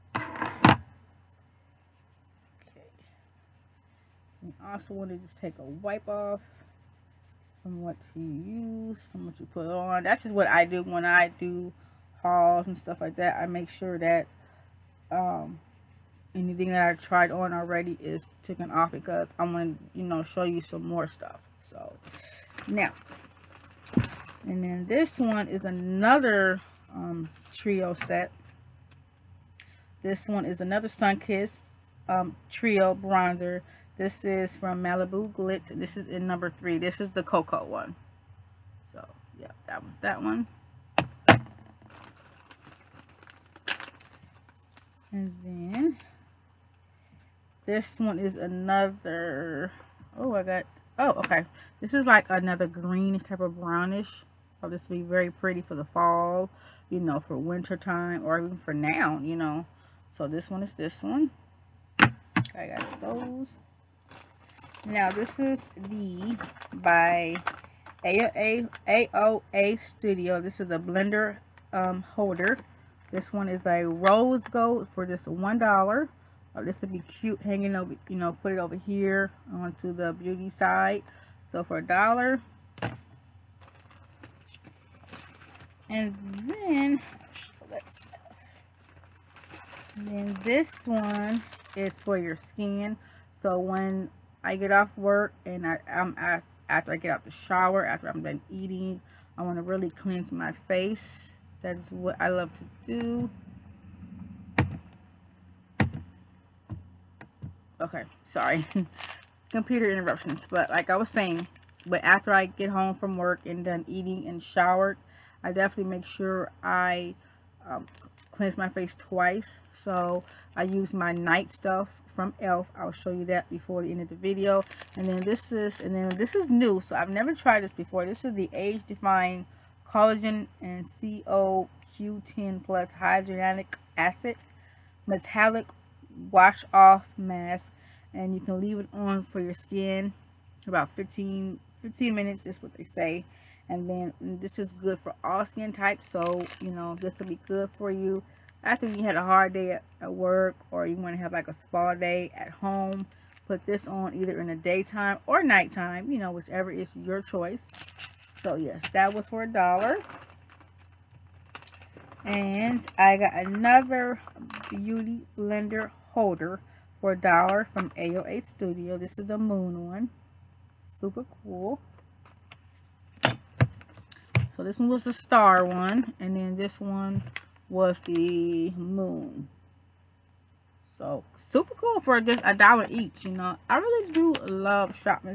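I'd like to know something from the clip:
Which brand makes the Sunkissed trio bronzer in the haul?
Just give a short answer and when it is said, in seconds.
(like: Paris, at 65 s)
Malibu Glitz, at 34 s.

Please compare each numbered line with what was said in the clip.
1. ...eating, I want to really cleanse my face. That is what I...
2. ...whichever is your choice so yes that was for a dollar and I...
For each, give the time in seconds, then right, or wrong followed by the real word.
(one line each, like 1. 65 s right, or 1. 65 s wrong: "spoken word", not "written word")
1. 98 s right
2. 156 s right.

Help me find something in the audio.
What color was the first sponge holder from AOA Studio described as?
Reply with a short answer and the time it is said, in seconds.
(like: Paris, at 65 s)
Rose gold, at 73 s.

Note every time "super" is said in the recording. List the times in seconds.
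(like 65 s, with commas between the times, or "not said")
171 s, 181 s.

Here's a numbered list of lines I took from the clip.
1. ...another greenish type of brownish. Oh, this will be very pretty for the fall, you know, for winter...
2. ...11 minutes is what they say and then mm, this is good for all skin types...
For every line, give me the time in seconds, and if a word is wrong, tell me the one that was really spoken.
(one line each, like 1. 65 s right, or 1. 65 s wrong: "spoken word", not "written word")
1. 52 s right
2. 141 s wrong: "15", not "11".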